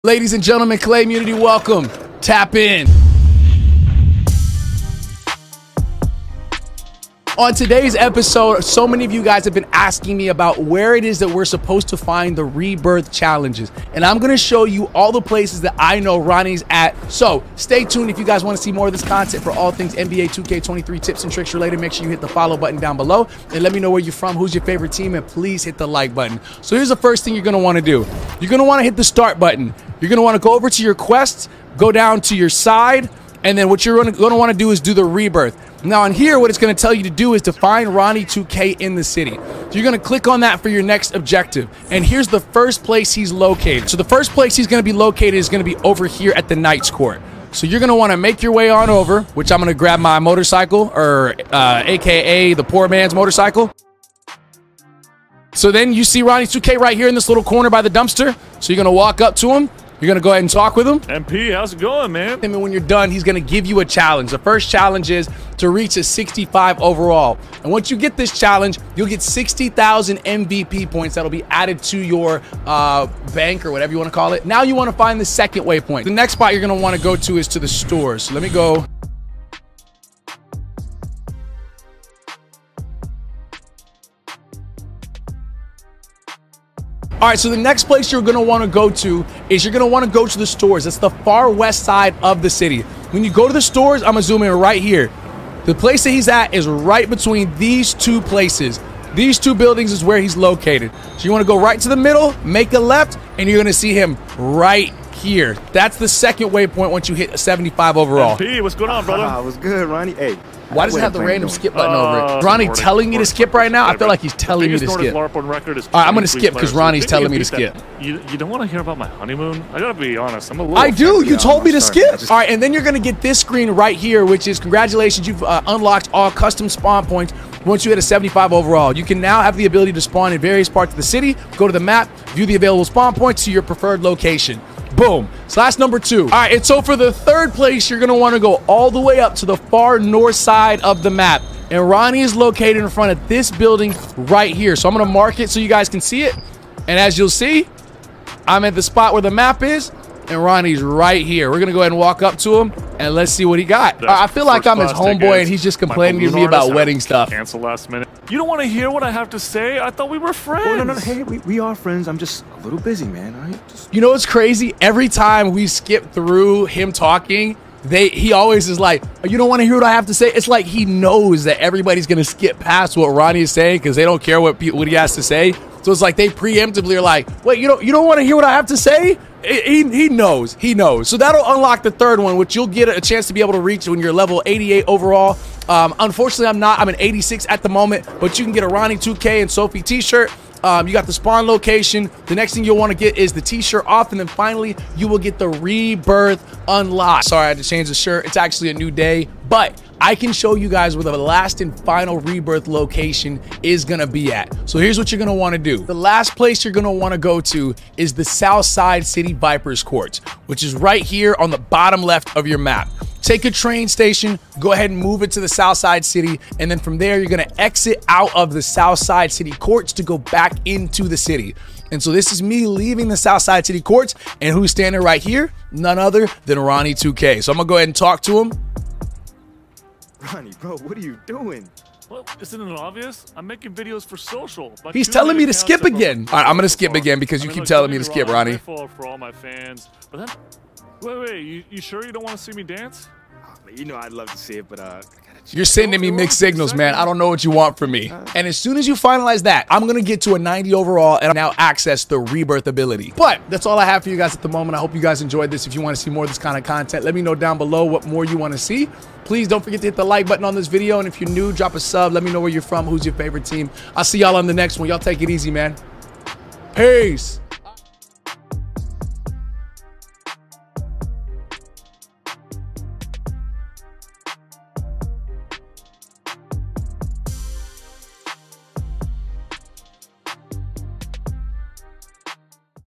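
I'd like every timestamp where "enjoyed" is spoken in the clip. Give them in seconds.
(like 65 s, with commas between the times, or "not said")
255 s.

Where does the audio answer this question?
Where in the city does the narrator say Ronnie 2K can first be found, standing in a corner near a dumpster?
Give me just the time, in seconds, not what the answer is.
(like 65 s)
46 s.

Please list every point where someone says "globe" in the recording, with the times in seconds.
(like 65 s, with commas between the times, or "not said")
not said.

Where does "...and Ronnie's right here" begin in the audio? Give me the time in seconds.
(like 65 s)
150 s.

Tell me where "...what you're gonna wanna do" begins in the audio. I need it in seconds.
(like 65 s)
204 s.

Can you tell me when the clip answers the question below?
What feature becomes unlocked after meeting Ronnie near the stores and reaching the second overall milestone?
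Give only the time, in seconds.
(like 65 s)
126 s.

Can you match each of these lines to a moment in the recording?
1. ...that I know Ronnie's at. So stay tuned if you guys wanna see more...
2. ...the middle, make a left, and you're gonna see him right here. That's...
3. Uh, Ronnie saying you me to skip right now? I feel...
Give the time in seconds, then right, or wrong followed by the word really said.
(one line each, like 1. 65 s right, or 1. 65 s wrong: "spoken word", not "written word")
1. 15 s right
2. 101 s right
3. 112 s wrong: "telling", not "saying".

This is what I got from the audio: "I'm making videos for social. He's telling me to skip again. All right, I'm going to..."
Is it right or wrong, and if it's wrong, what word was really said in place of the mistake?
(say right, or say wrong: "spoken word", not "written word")
right.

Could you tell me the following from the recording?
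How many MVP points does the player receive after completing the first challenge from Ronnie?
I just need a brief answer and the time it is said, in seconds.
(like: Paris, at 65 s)
60,000, at 69 s.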